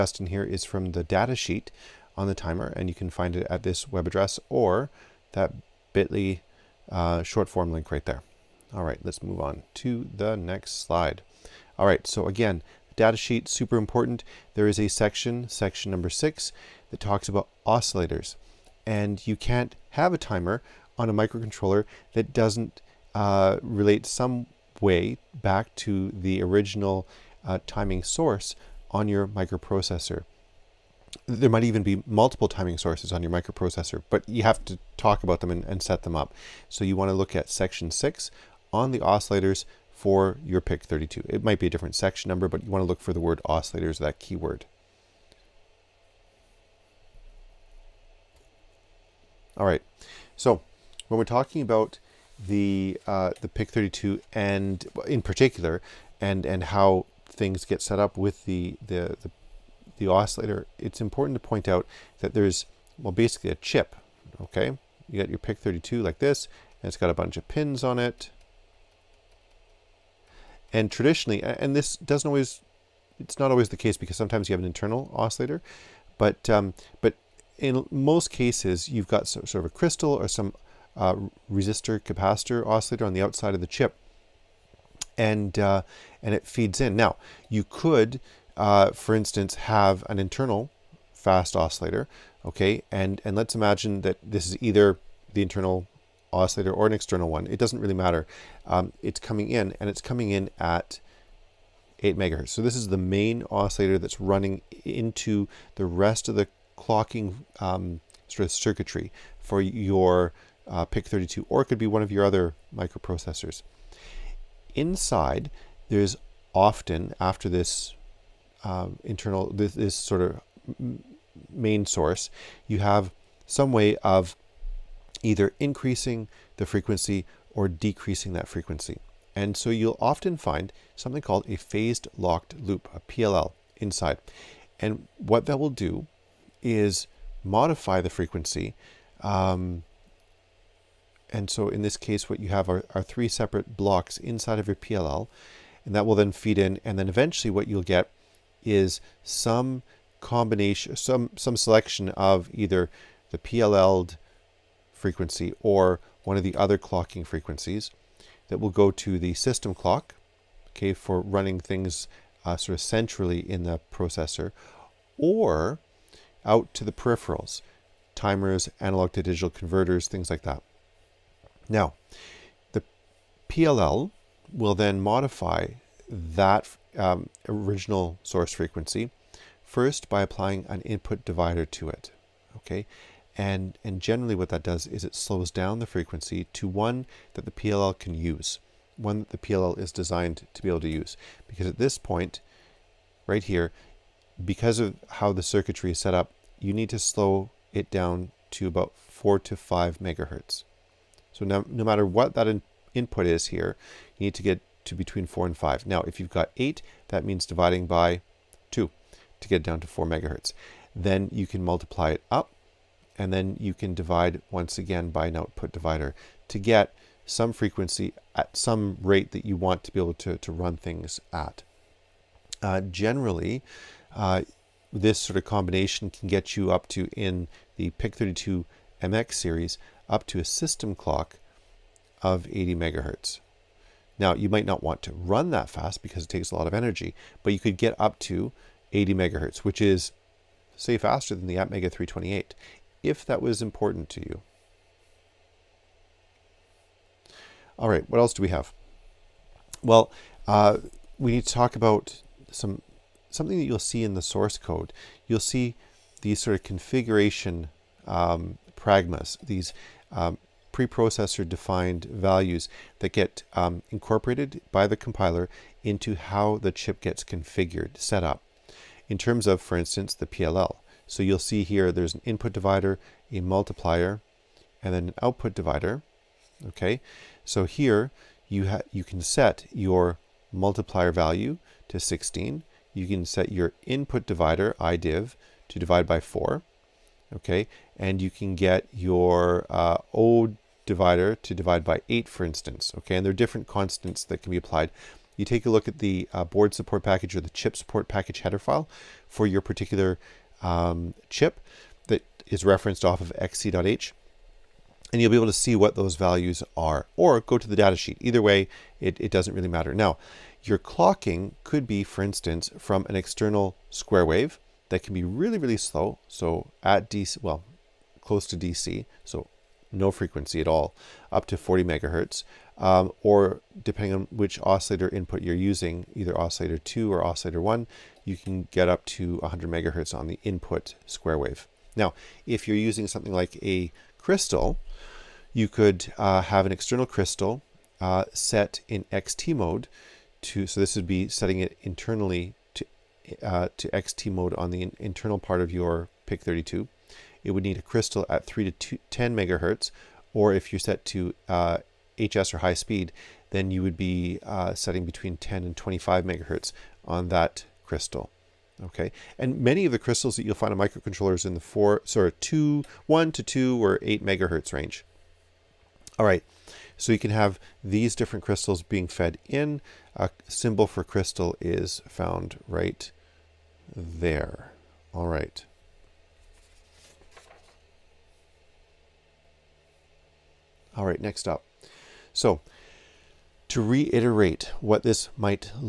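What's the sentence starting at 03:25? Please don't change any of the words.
Now, if you've got 8, that means dividing by 2 to get down to 4 megahertz.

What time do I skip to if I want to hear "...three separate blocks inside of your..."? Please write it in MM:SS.
02:23.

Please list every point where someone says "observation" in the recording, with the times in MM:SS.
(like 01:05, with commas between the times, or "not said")
not said.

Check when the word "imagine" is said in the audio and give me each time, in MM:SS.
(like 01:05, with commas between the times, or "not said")
01:33.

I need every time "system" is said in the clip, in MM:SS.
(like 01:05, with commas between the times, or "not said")
02:39, 03:50.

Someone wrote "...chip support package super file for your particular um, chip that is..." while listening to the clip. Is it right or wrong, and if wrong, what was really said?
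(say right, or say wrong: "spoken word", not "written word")
wrong: "header", not "super".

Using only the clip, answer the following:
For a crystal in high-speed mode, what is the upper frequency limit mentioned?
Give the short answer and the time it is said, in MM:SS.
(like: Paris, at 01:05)
25 megahertz, at 05:55.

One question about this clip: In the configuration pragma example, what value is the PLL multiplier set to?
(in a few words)
16.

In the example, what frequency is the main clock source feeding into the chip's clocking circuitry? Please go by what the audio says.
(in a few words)
8 megahertz.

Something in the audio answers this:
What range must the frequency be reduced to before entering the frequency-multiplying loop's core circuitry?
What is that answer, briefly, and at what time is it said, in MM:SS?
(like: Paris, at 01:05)
4 to 5 megahertz, at 03:19.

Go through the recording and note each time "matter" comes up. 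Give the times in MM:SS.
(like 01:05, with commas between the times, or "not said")
01:37, 03:21, 05:09.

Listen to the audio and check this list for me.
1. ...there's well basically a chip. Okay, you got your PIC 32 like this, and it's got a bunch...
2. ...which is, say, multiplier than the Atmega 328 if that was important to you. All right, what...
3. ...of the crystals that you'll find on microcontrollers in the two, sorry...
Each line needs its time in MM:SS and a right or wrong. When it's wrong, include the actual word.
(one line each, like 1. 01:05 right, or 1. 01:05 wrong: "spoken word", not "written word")
1. 01:02 right
2. 03:59 wrong: "faster", not "multiplier"
3. 05:59 wrong: "four", not "two".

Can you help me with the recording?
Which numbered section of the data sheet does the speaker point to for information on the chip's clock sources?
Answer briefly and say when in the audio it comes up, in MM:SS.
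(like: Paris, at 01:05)
section 6, at 00:15.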